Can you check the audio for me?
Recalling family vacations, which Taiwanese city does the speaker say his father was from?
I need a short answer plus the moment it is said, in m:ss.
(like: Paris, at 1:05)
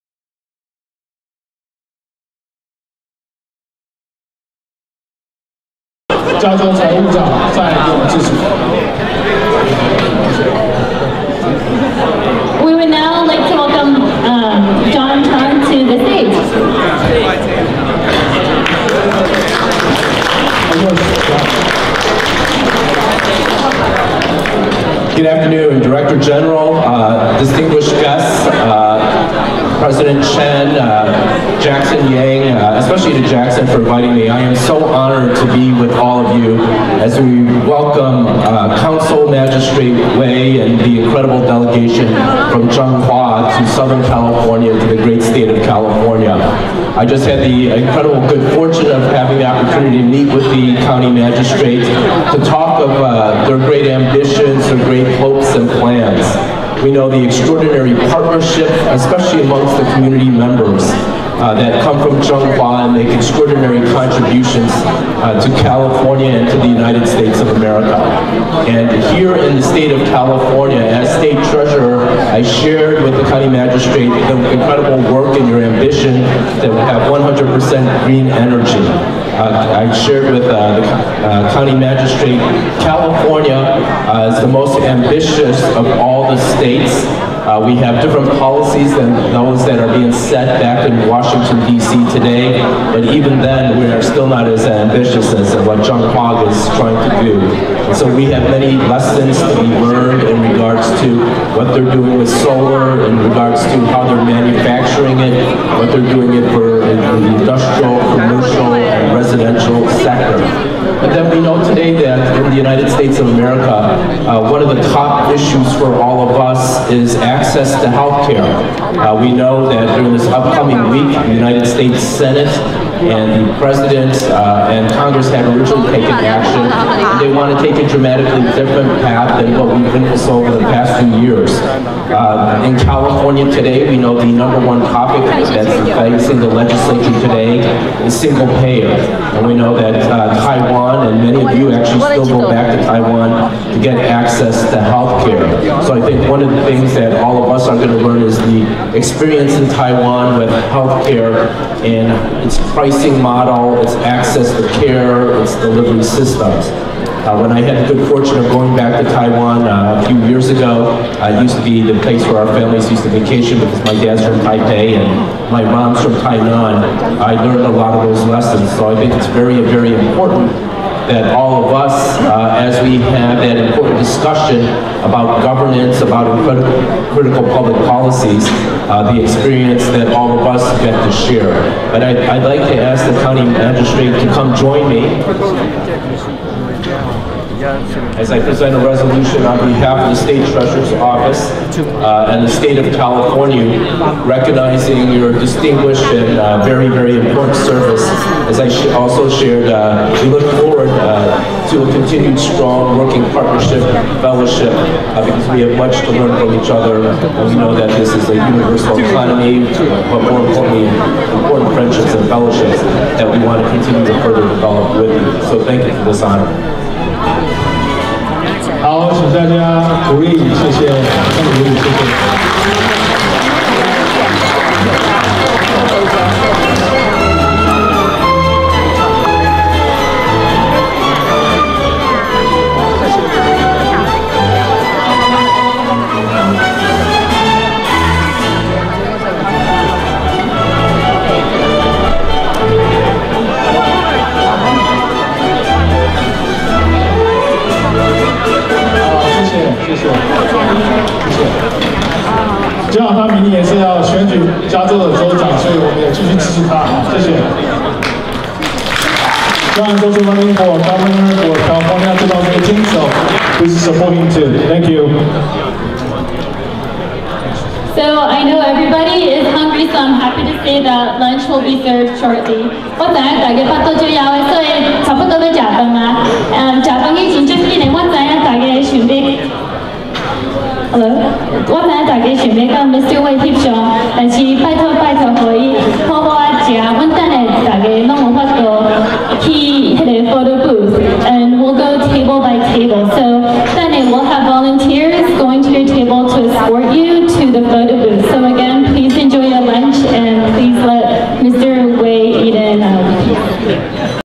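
Taipei, at 2:44.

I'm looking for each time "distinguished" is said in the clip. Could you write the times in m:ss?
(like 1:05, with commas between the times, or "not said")
0:27, 3:15.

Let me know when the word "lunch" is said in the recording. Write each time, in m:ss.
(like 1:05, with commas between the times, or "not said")
4:31.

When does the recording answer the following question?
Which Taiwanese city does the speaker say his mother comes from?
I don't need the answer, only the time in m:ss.
2:46.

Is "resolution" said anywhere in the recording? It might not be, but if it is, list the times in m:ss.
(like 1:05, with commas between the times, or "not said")
3:08.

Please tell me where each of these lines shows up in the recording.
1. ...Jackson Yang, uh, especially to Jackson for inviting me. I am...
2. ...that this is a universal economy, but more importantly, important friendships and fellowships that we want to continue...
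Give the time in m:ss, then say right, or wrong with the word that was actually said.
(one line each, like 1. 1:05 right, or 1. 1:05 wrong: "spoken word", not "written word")
1. 0:31 right
2. 3:27 right.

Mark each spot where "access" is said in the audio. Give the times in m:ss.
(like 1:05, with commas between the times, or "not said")
1:57, 2:24, 2:34.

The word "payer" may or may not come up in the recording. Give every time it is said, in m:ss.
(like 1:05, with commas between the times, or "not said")
2:18.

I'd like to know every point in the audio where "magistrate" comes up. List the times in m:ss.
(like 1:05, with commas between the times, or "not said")
0:39, 0:51, 1:13, 1:21, 3:03.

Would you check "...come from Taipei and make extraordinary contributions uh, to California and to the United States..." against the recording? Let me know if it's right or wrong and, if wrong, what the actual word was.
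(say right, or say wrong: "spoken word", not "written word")
wrong: "Changhua", not "Taipei".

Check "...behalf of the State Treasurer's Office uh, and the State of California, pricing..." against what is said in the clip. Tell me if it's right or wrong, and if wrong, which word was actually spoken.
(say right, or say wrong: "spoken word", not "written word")
wrong: "recognizing", not "pricing".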